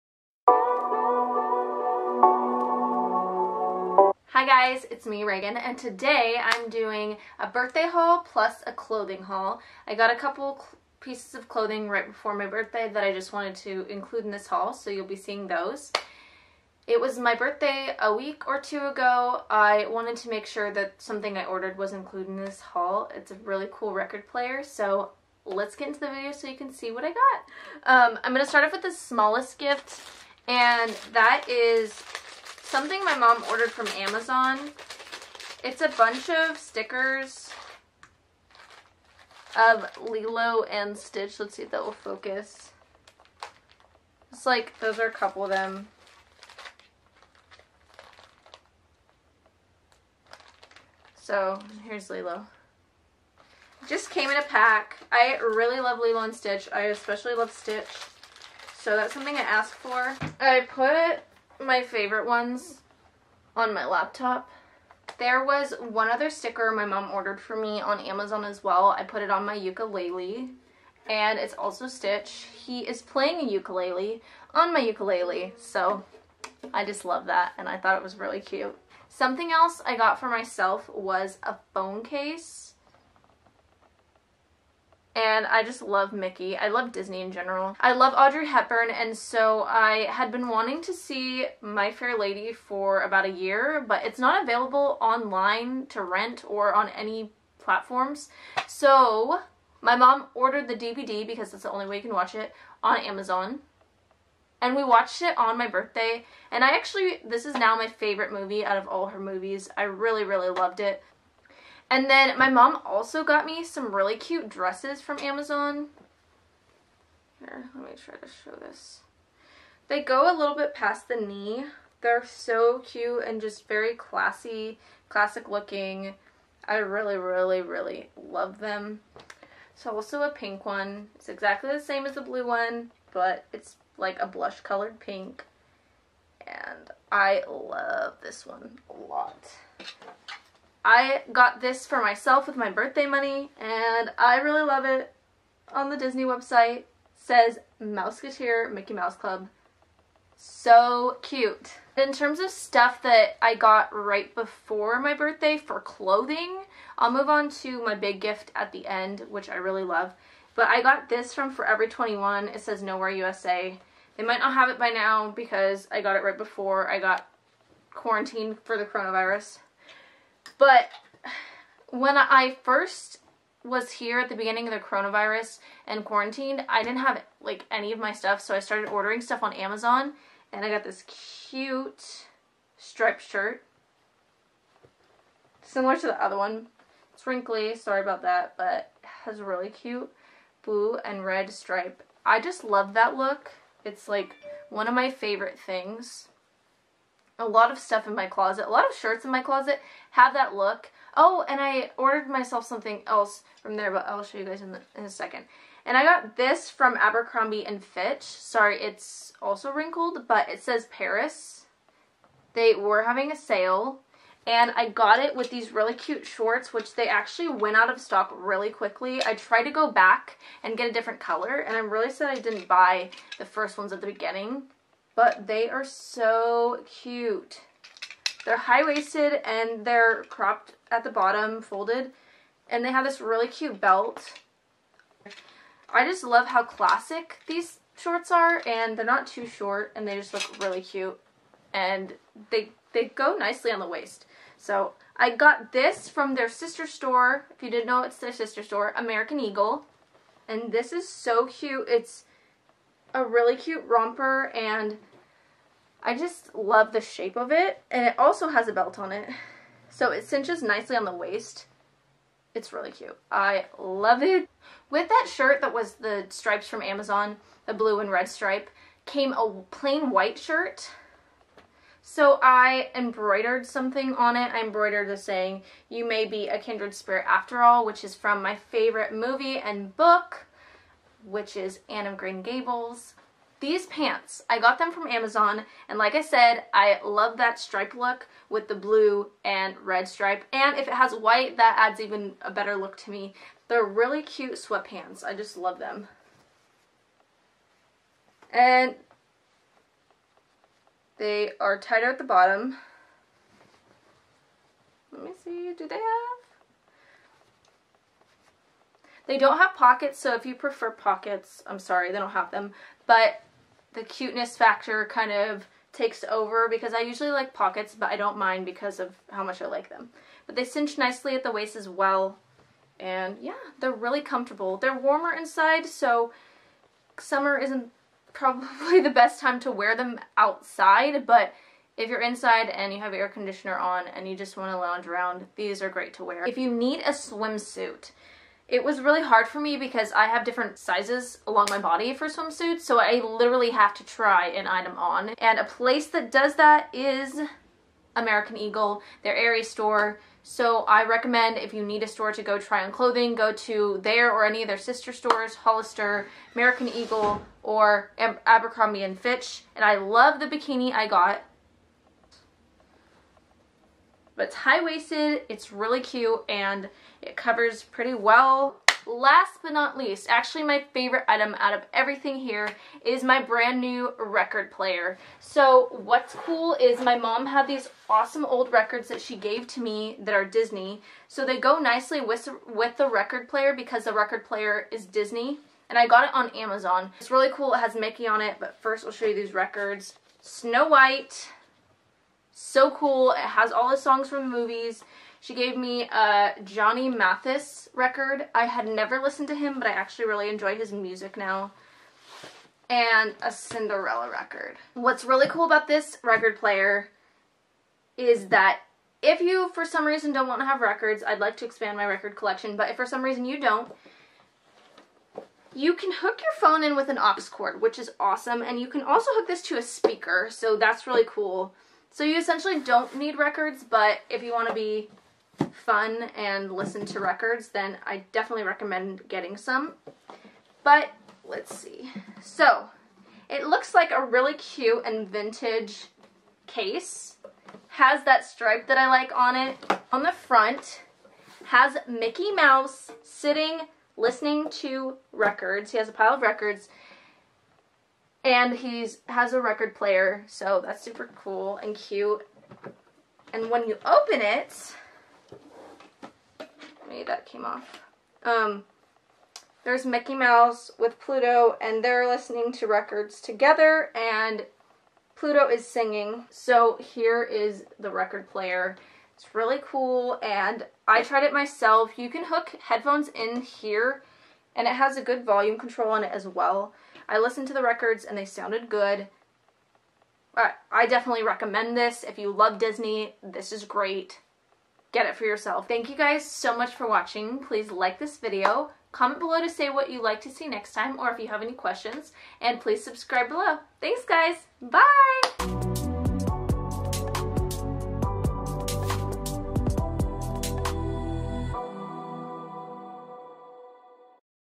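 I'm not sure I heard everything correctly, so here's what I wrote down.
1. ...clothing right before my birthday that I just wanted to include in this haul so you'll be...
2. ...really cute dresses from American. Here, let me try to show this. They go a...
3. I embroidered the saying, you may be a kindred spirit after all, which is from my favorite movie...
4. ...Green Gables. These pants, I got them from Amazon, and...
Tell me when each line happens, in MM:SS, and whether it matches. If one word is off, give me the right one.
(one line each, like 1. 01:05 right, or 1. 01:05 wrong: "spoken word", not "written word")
1. 00:11 right
2. 01:53 wrong: "Amazon", not "American"
3. 04:34 right
4. 04:42 right.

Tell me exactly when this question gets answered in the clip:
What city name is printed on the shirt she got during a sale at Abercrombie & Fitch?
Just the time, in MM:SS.
03:30.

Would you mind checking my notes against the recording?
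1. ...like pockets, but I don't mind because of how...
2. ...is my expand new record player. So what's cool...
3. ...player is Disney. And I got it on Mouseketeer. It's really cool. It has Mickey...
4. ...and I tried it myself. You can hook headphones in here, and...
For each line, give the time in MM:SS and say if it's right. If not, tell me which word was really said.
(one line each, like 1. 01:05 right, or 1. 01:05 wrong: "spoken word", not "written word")
1. 05:17 right
2. 06:13 wrong: "brand", not "expand"
3. 06:24 wrong: "Amazon", not "Mouseketeer"
4. 07:50 right.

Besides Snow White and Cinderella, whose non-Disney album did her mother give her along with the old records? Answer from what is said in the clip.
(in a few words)
Johnny Mathis.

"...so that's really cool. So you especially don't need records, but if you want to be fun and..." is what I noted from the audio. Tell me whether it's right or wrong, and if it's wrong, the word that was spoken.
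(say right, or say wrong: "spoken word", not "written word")
wrong: "essentially", not "especially".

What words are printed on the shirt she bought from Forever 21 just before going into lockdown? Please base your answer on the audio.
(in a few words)
Nowhere USA.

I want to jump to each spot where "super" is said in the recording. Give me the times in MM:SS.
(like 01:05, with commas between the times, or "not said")
07:31.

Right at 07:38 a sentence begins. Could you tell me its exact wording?
Um, there's Mickey Mouse with Pluto, and they're listening to records together, and Pluto is singing.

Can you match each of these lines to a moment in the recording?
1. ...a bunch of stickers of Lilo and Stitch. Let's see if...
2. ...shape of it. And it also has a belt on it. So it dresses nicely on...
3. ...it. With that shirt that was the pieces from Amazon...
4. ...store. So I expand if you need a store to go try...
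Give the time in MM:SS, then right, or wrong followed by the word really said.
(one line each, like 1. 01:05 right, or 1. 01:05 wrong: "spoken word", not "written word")
1. 00:35 right
2. 04:17 wrong: "cinches", not "dresses"
3. 04:24 wrong: "stripes", not "pieces"
4. 05:49 wrong: "recommend", not "expand".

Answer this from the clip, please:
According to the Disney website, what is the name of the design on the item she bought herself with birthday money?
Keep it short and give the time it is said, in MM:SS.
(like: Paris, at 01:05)
Mouseketeer Mickey Mouse Club, at 02:27.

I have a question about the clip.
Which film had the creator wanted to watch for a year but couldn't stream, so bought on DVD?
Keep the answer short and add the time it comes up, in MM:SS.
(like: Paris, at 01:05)
My Fair Lady, at 01:31.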